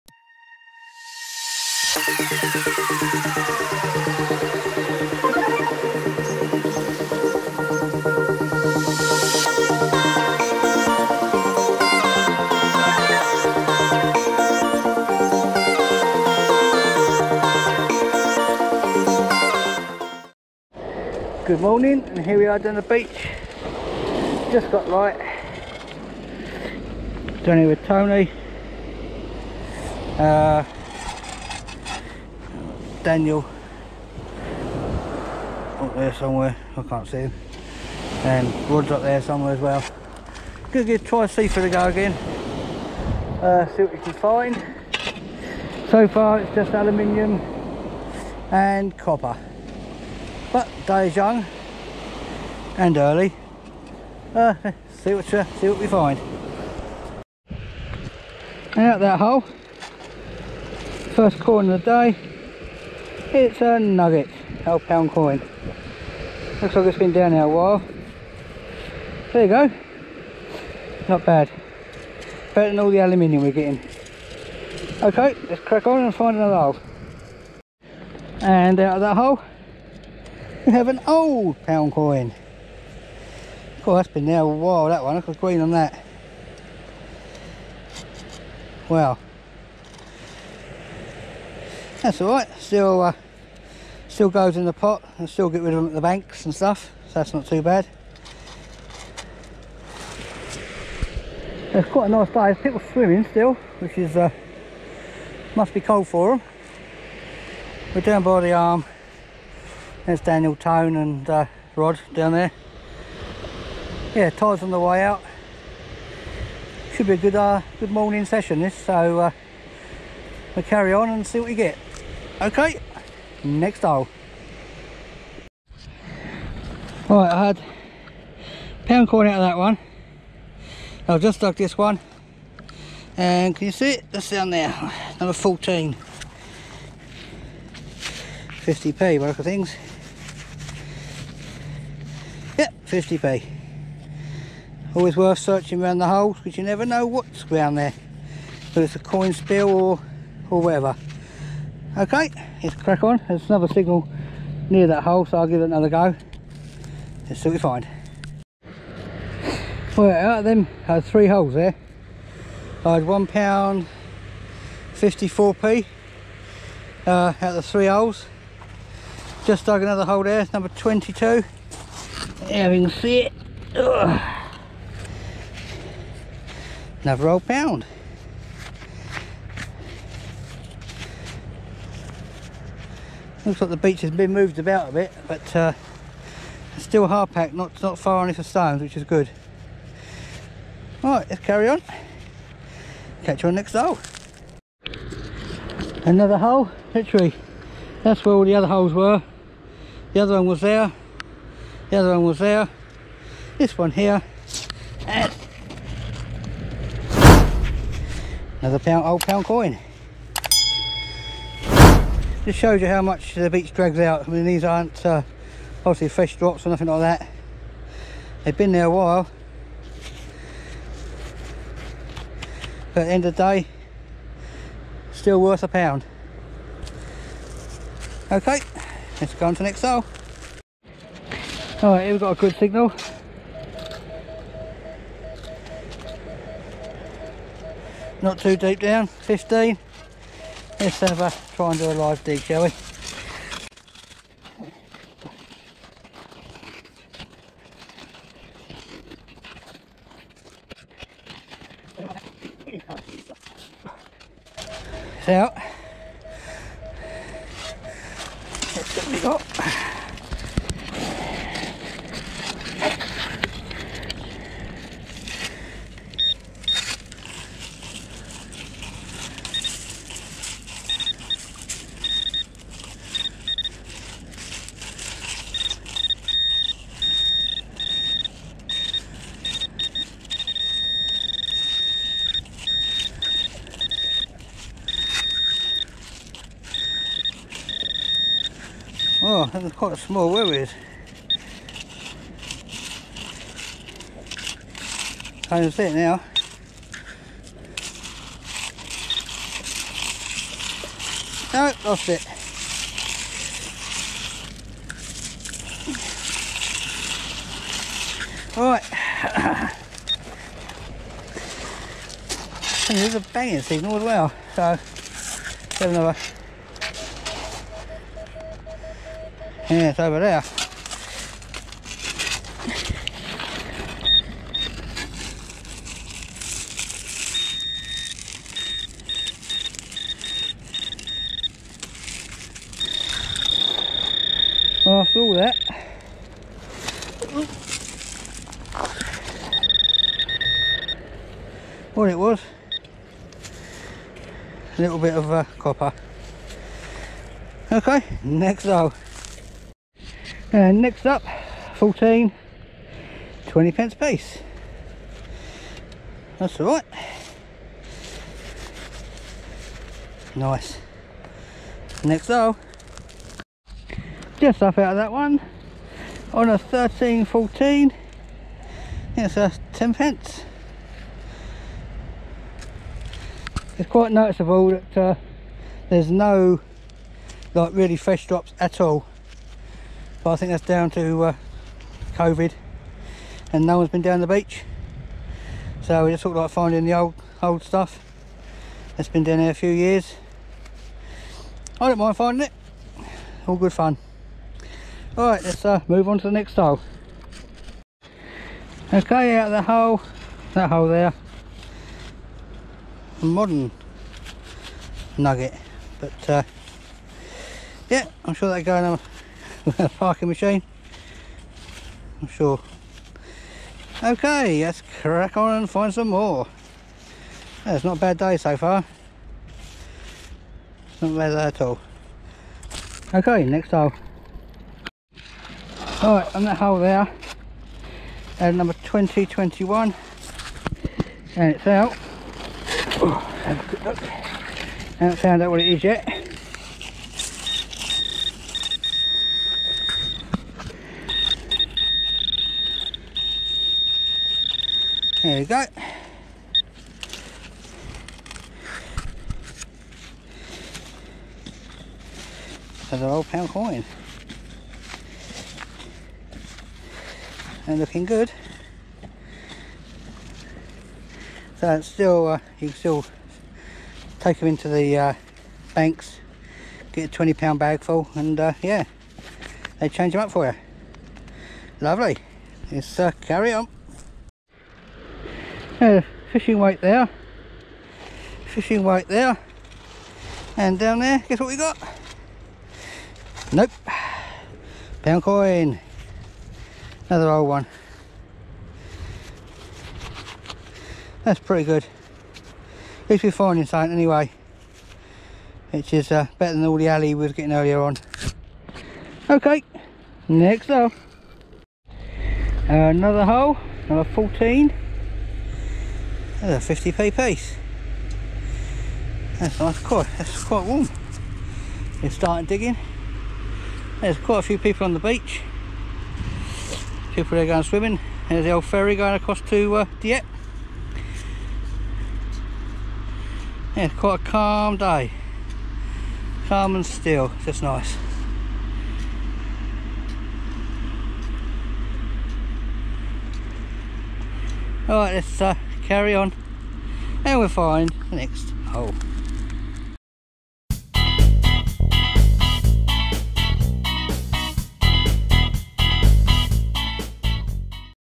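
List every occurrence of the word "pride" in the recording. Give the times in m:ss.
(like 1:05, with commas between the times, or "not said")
not said.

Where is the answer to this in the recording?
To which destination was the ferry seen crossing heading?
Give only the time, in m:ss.
8:39.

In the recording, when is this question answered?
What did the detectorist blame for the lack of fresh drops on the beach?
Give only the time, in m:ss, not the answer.
6:22.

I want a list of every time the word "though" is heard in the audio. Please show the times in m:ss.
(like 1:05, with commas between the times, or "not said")
5:48, 6:02.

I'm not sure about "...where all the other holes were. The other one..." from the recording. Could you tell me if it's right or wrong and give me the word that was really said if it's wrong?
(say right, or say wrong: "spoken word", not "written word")
right.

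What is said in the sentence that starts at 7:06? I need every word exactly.
Alright, on that hole there, and number 2021, and it's out.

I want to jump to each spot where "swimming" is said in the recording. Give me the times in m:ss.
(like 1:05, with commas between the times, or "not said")
1:42, 8:37.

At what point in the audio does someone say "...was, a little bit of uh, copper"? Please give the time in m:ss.
5:42.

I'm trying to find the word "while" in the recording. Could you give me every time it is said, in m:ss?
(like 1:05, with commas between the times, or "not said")
1:07, 1:24, 3:38.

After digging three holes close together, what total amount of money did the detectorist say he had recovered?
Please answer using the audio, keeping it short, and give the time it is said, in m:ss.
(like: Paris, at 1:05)
£1.54, at 2:43.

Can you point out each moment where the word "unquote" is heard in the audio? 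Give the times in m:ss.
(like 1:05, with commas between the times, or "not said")
not said.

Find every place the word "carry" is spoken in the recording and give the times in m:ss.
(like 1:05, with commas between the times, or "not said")
2:00, 3:11, 7:53, 8:55.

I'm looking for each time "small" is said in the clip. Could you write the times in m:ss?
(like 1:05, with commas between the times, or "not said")
4:49.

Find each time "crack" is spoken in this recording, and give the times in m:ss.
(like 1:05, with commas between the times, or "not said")
1:15, 2:32, 6:55.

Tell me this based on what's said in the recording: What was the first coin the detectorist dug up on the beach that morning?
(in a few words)
half pound coin.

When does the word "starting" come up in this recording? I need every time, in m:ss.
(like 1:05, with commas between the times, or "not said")
8:32.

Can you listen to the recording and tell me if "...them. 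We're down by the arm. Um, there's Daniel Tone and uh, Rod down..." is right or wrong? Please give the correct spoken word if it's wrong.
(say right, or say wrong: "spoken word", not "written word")
right.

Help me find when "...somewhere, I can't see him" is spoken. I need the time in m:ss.
0:36.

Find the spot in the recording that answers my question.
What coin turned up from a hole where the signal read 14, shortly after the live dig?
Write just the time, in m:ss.
5:53.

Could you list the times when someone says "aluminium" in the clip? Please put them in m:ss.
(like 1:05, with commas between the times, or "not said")
0:46, 1:12.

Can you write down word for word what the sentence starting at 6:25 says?
So we just sort of like finding the old old stuff that's been down there a few years.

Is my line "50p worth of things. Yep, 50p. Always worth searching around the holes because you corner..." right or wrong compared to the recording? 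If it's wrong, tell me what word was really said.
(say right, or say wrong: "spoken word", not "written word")
wrong: "never", not "corner".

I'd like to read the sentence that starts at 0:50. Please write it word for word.
But day is young and early.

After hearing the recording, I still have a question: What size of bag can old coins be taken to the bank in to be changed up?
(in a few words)
20 pound bag.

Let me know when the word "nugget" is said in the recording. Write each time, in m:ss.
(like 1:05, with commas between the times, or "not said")
1:03, 6:45.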